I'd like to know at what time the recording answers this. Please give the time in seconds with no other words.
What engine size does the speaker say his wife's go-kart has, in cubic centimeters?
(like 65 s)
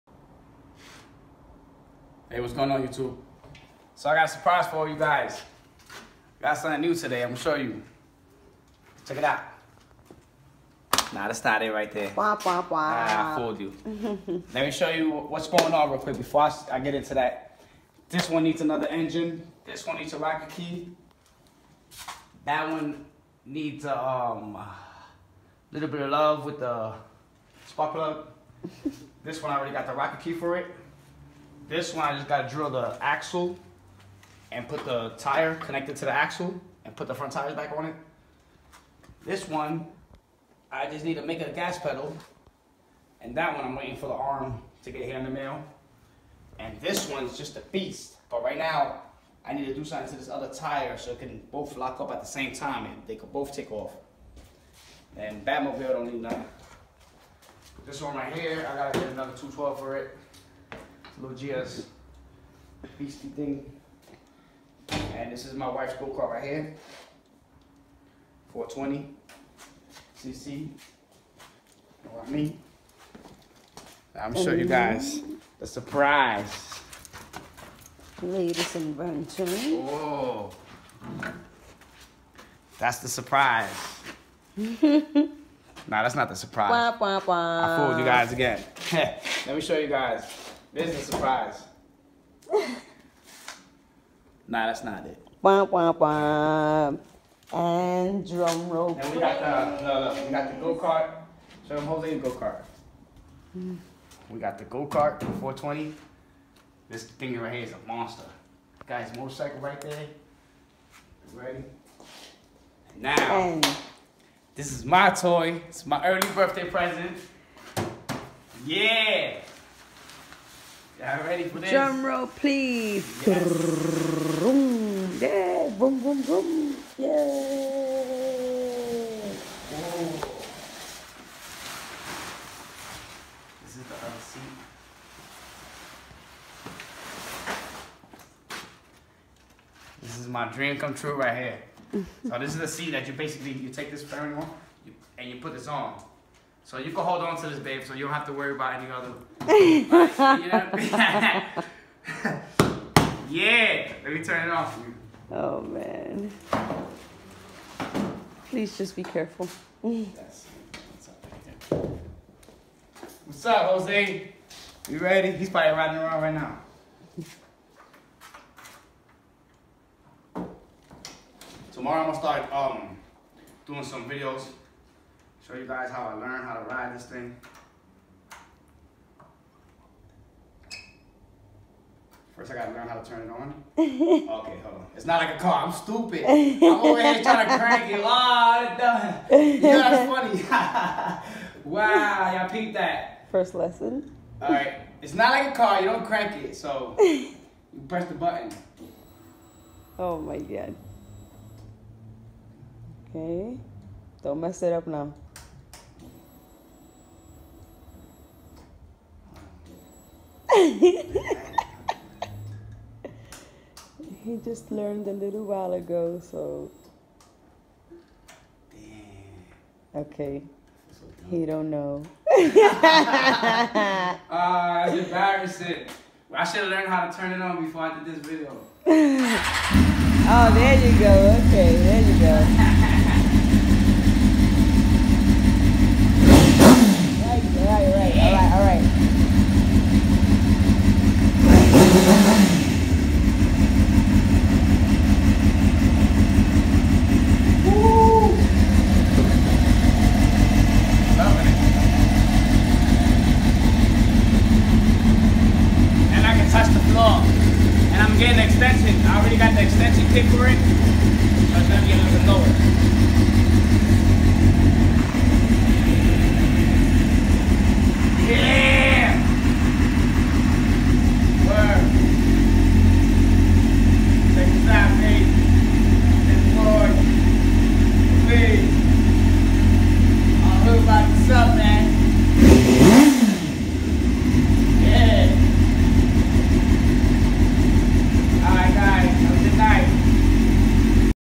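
68 s.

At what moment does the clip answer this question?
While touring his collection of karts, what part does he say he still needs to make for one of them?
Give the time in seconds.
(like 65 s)
41 s.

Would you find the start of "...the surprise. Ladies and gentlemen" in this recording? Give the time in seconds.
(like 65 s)
75 s.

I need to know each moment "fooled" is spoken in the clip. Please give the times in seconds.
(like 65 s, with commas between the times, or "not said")
13 s, 87 s.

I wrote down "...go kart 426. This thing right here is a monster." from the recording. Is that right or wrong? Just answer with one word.
wrong.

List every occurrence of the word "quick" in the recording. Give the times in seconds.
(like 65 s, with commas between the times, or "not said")
15 s.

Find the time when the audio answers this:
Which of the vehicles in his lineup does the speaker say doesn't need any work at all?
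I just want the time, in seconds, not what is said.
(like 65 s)
55 s.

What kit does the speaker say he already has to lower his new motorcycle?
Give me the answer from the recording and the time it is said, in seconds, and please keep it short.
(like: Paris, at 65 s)
extension kit, at 259 s.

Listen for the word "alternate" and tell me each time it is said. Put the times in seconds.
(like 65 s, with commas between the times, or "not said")
not said.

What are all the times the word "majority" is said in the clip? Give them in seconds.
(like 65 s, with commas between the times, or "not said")
not said.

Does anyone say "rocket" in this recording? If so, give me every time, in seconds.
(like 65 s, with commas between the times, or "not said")
20 s, 29 s.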